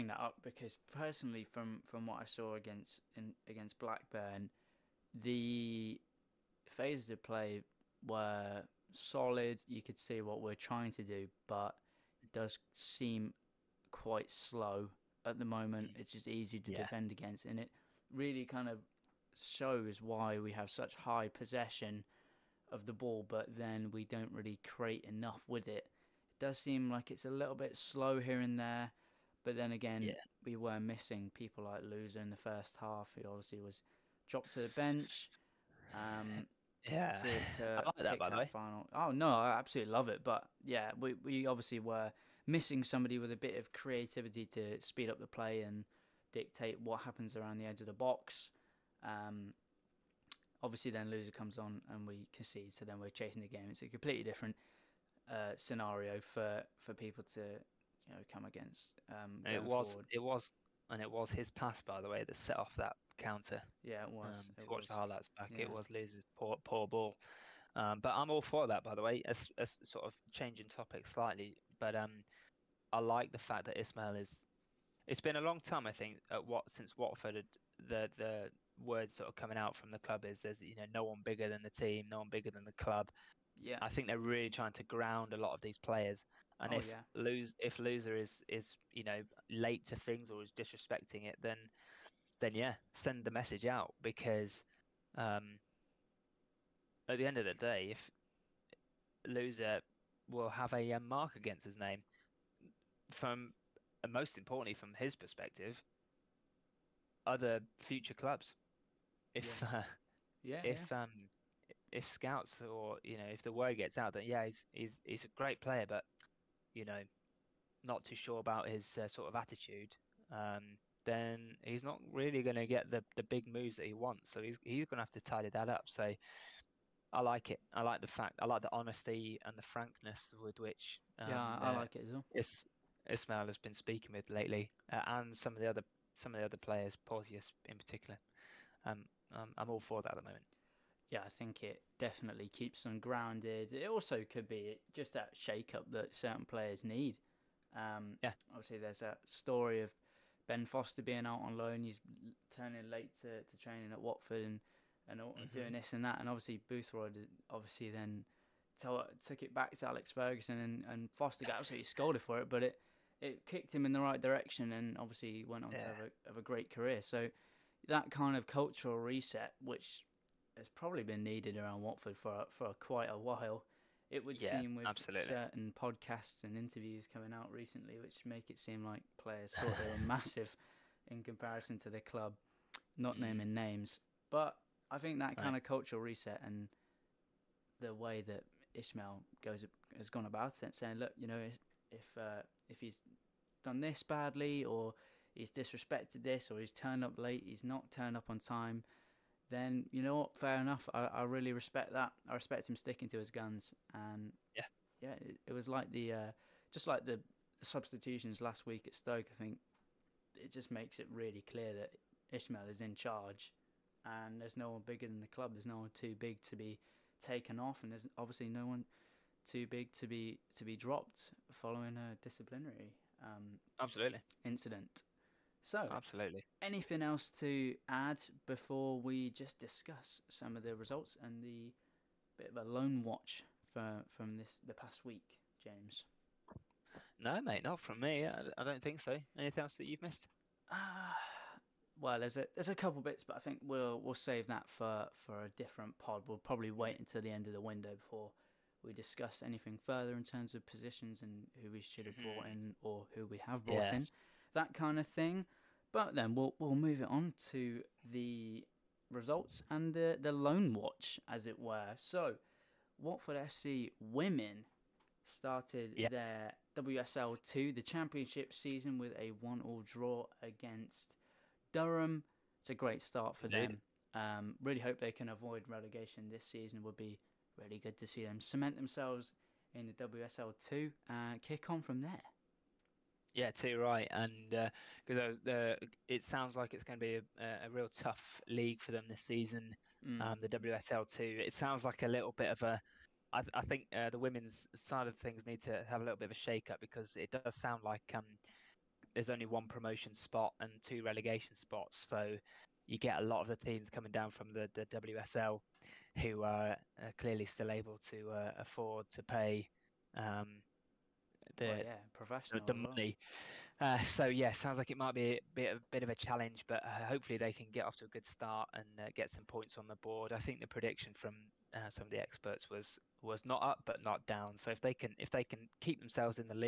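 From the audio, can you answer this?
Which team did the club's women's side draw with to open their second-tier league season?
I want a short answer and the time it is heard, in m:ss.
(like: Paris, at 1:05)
Durham, at 4:31.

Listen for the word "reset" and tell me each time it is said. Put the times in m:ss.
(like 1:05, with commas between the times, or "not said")
2:48, 3:06.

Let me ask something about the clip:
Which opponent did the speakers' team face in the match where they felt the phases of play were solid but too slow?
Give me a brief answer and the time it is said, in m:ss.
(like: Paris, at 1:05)
Blackburn, at 0:03.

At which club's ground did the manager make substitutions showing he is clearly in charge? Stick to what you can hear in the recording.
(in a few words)
Stoke.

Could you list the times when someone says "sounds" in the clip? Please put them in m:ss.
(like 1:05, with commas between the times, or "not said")
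4:46, 4:51, 4:57, 5:14.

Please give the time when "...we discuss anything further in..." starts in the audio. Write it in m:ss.
4:08.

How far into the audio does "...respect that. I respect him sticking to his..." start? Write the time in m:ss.
3:21.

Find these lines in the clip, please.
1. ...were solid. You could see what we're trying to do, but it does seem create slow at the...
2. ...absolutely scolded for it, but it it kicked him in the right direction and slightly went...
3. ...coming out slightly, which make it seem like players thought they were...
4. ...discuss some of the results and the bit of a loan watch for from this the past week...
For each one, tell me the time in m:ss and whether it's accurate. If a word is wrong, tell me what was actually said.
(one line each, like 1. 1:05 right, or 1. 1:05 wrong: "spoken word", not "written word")
1. 0:08 wrong: "quite", not "create"
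2. 2:41 wrong: "obviously", not "slightly"
3. 2:57 wrong: "recently", not "slightly"
4. 3:49 right.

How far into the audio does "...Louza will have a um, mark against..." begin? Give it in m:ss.
1:39.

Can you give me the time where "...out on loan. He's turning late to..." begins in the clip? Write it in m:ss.
2:31.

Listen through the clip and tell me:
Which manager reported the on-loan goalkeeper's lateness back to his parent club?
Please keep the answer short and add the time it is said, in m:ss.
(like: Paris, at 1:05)
Boothroyd, at 2:36.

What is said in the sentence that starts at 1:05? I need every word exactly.
it was Louza's poor, poor ball.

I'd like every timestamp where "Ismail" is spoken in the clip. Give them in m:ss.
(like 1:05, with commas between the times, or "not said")
1:13, 2:13.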